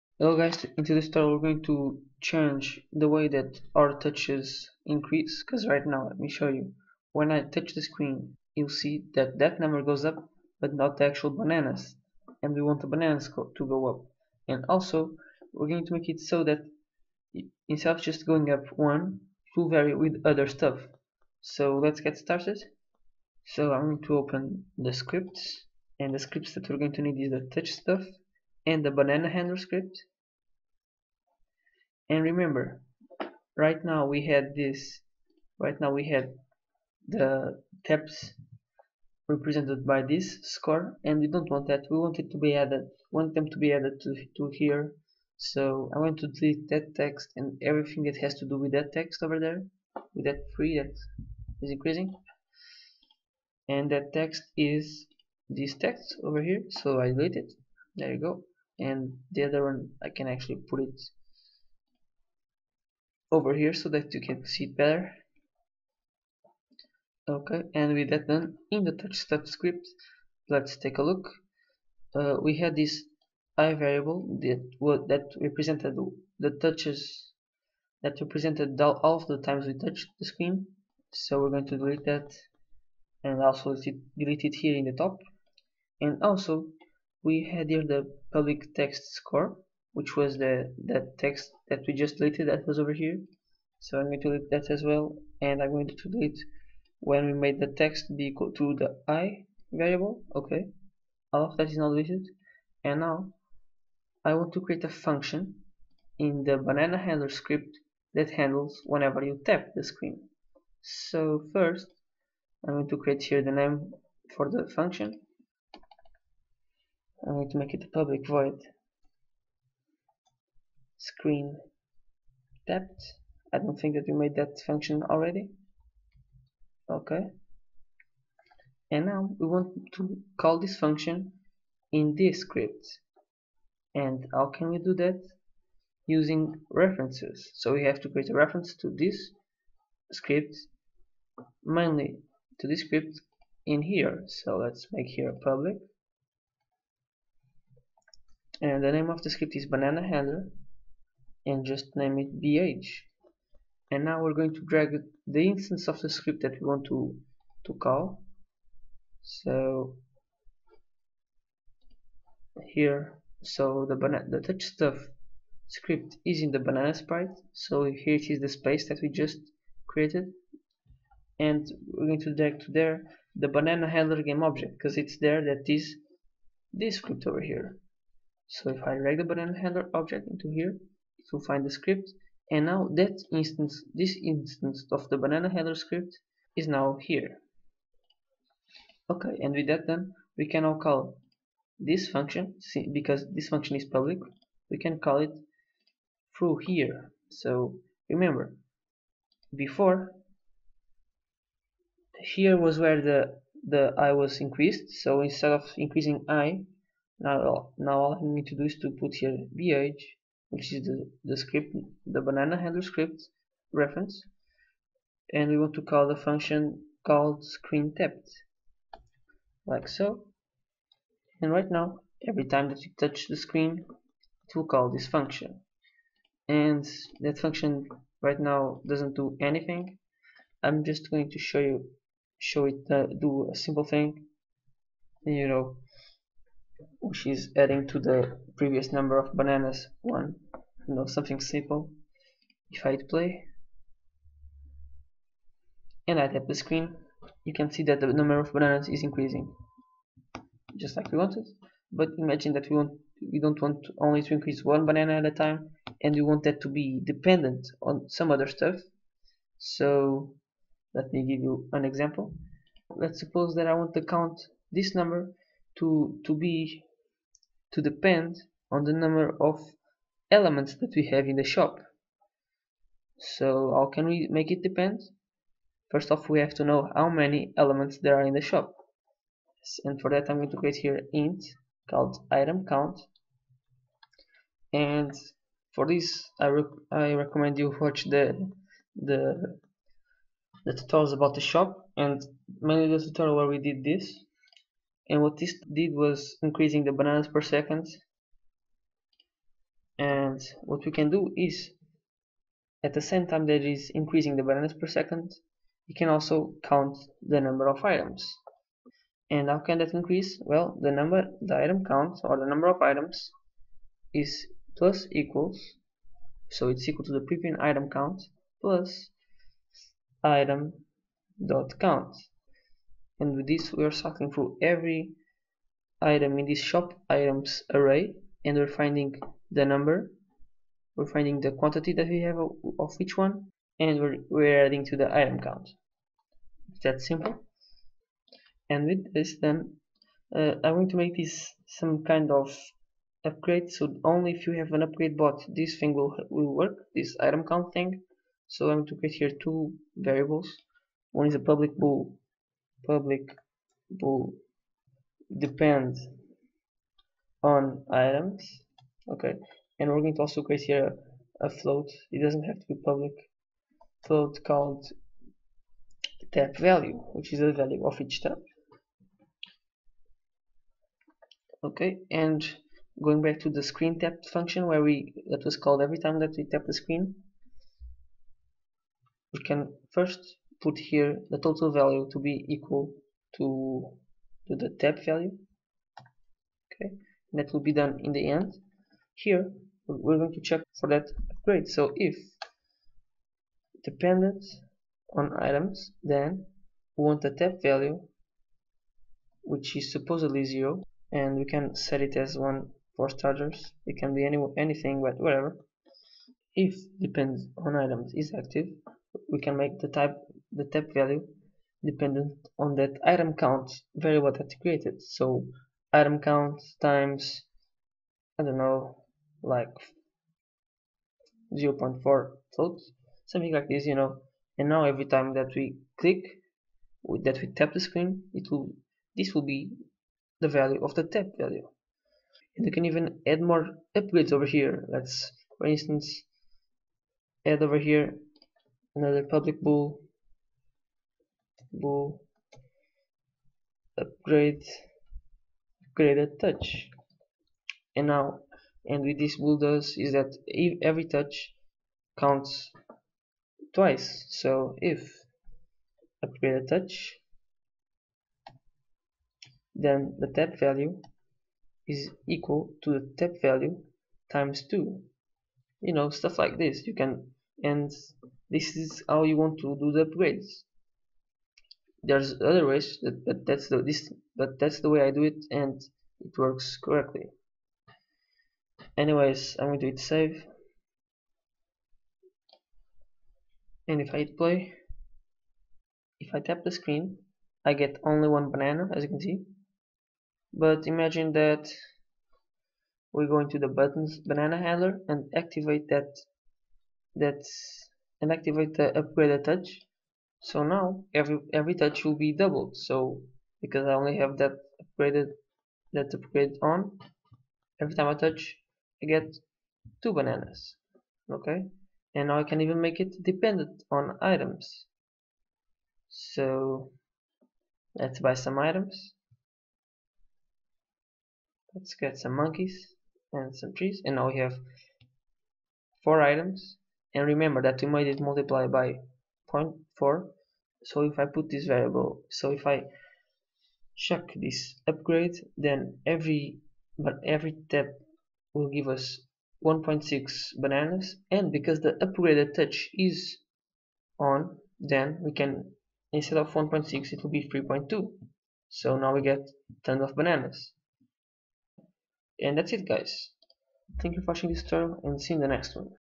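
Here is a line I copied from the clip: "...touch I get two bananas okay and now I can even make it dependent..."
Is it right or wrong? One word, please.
right.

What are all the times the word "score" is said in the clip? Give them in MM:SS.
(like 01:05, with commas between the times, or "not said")
00:40, 01:29.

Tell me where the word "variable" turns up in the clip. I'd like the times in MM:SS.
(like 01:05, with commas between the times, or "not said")
01:13, 01:39, 05:49, 06:53, 08:51.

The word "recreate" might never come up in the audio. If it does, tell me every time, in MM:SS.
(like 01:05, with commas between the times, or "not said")
not said.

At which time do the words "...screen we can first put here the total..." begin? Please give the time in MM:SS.
06:16.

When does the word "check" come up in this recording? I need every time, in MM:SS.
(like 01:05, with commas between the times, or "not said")
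06:30, 08:53.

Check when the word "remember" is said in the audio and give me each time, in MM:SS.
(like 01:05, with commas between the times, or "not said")
00:32, 03:18, 08:47.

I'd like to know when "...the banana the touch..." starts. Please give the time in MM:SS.
02:43.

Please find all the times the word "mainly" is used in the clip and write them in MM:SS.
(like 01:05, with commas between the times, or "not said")
02:21, 04:52.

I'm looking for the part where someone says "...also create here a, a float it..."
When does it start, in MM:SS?
06:00.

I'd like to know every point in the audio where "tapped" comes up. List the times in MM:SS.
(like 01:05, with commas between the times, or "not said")
02:02, 03:37.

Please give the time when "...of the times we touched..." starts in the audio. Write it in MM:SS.
01:19.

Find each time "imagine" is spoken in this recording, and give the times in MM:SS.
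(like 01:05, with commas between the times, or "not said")
04:12, 08:10.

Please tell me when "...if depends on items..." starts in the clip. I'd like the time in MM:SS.
06:46.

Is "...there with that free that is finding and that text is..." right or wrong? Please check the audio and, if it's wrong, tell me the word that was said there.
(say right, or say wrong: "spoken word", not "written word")
wrong: "increasing", not "finding".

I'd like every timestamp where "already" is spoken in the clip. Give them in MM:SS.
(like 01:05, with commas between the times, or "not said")
02:05.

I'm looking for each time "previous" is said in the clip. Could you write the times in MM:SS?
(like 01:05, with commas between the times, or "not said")
03:58, 05:17.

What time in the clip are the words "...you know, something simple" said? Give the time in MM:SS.
04:00.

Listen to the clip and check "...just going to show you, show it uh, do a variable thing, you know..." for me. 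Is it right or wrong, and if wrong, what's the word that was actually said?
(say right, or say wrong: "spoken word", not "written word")
wrong: "simple", not "variable".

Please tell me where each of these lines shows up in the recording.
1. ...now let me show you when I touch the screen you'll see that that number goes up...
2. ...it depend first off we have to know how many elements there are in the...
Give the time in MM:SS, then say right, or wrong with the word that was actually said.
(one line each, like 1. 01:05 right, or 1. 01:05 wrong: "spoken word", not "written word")
1. 00:05 right
2. 04:34 right.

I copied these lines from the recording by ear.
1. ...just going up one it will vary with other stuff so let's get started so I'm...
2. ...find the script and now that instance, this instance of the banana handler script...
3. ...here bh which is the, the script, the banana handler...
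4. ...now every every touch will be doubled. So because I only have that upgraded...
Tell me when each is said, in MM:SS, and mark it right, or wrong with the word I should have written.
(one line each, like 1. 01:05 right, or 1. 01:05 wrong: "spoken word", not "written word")
1. 00:18 right
2. 03:01 right
3. 03:29 right
4. 08:20 right.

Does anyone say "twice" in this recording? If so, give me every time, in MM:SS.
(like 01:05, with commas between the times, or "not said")
07:33.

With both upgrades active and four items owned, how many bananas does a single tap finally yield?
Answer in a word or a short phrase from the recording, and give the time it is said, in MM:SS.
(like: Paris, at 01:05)
3.2, at 09:07.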